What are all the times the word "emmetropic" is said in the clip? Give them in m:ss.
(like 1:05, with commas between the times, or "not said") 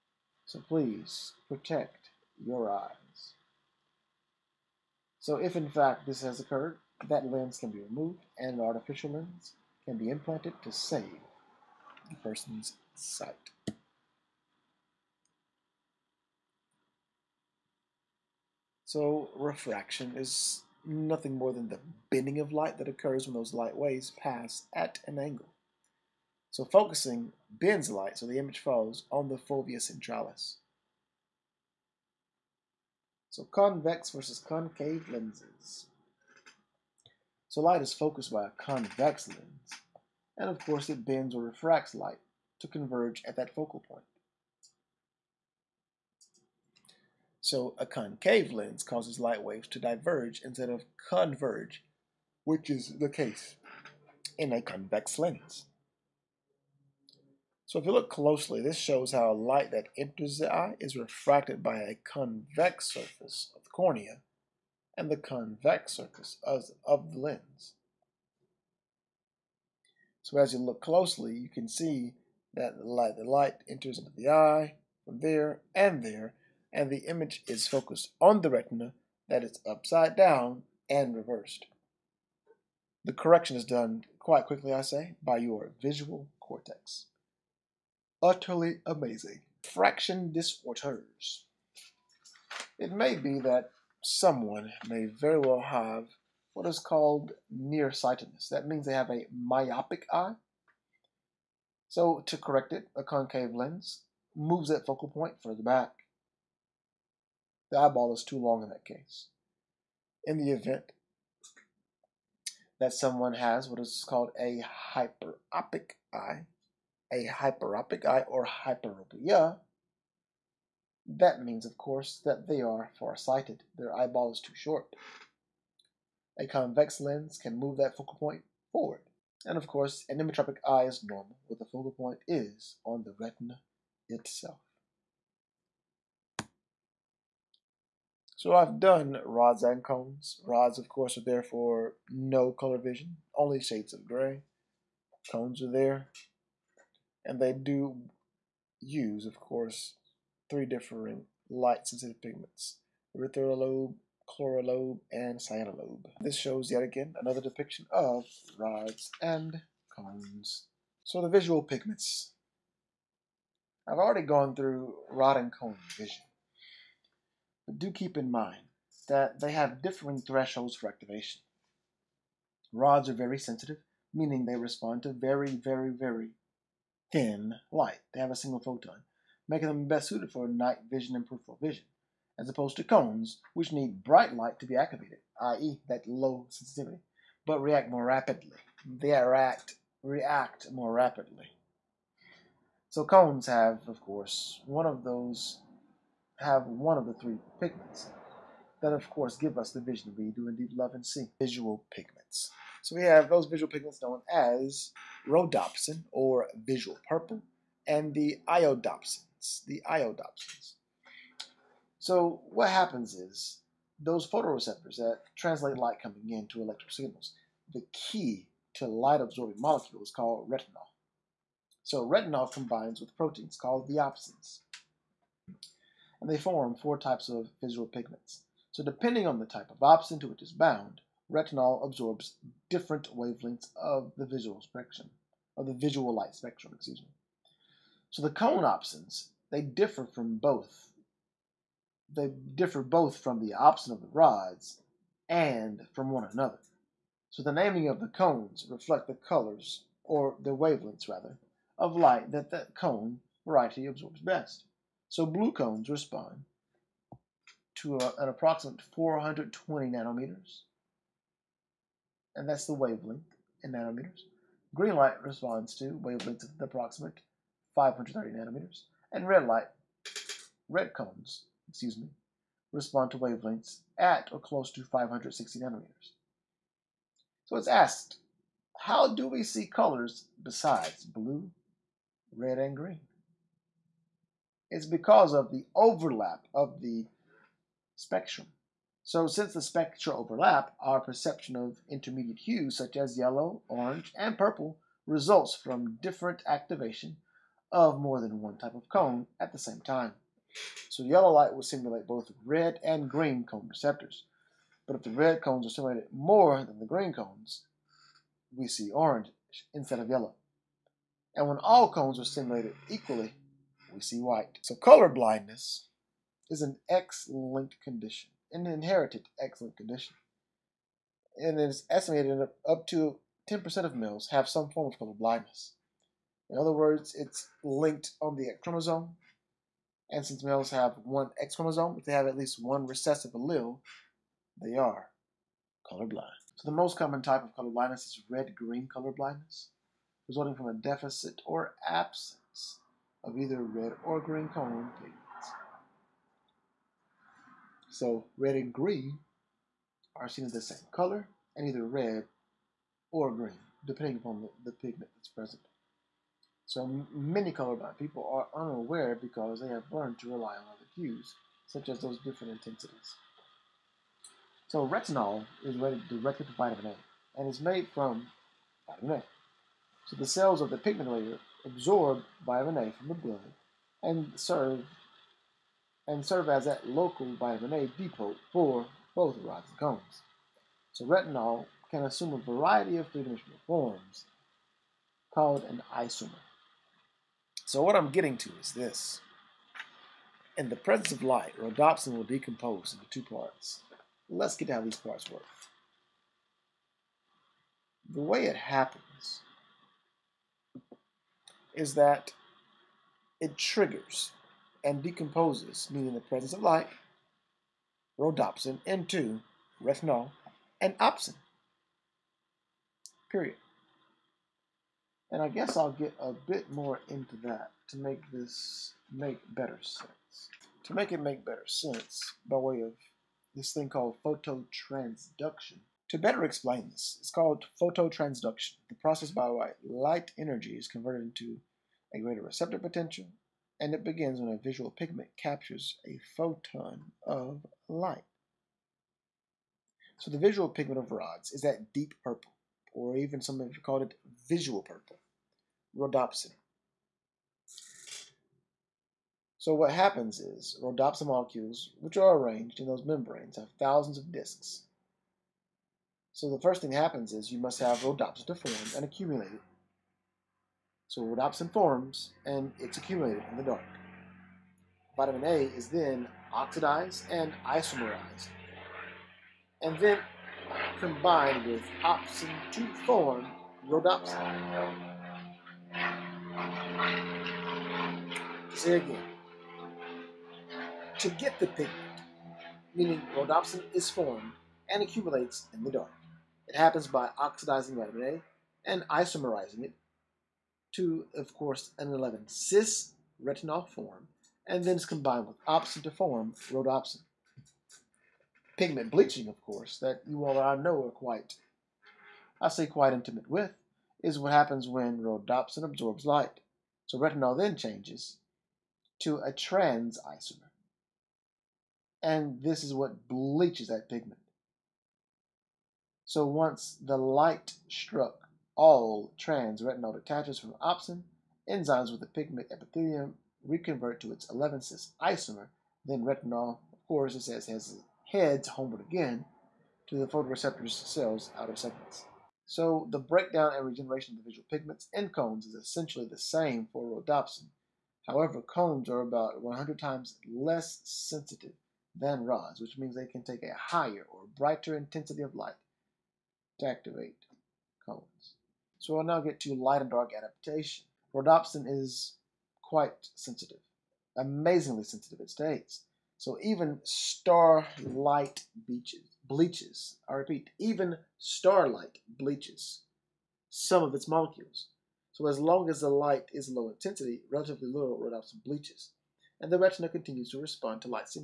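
2:10.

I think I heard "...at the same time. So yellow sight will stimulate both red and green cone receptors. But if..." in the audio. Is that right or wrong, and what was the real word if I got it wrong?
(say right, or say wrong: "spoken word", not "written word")
wrong: "light", not "sight".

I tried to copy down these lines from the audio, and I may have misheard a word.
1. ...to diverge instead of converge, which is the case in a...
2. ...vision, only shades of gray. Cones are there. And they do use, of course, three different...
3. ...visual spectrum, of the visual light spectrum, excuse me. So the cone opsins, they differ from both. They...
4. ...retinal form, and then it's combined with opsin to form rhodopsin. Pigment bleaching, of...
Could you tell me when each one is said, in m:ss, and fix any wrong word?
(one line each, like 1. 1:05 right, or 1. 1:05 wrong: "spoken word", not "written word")
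1. 0:49 right
2. 2:22 right
3. 3:54 right
4. 8:13 right.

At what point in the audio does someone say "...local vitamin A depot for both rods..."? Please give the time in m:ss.
6:16.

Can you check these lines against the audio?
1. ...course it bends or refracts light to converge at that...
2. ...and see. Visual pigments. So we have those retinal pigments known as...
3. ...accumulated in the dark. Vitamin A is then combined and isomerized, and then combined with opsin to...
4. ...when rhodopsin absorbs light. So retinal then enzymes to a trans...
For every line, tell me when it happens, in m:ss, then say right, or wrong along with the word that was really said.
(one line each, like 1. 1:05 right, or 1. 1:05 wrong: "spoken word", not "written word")
1. 0:40 right
2. 3:20 wrong: "visual", not "retinal"
3. 7:42 wrong: "oxidized", not "combined"
4. 8:24 wrong: "changes", not "enzymes".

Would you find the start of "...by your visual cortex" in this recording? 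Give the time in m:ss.
1:25.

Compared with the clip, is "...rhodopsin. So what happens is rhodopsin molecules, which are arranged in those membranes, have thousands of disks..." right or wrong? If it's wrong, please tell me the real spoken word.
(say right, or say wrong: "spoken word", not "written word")
right.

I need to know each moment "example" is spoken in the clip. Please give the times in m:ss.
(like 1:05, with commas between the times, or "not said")
not said.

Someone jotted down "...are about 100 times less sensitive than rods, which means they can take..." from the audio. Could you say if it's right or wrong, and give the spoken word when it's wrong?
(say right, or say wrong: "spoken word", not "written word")
right.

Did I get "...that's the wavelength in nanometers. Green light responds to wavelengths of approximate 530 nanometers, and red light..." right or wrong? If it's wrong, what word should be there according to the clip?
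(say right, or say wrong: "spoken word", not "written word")
right.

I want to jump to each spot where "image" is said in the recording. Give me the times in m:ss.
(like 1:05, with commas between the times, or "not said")
0:28, 1:17.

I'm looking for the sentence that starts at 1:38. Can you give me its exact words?
That means they have a myopic eye.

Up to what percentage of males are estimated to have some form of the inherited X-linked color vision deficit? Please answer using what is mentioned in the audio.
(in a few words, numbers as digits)
10%.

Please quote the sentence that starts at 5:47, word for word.
So red and green are seen as the same color and either red or green, depending upon the, the pigment that's present.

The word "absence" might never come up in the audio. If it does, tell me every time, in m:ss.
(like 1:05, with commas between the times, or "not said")
5:41.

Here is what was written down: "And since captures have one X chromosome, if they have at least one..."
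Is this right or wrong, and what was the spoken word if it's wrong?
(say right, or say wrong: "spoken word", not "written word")
wrong: "males", not "captures".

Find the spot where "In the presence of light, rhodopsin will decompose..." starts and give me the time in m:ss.
6:30.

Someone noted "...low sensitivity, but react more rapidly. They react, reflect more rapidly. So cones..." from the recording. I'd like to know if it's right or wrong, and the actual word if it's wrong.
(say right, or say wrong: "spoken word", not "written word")
wrong: "react", not "reflect".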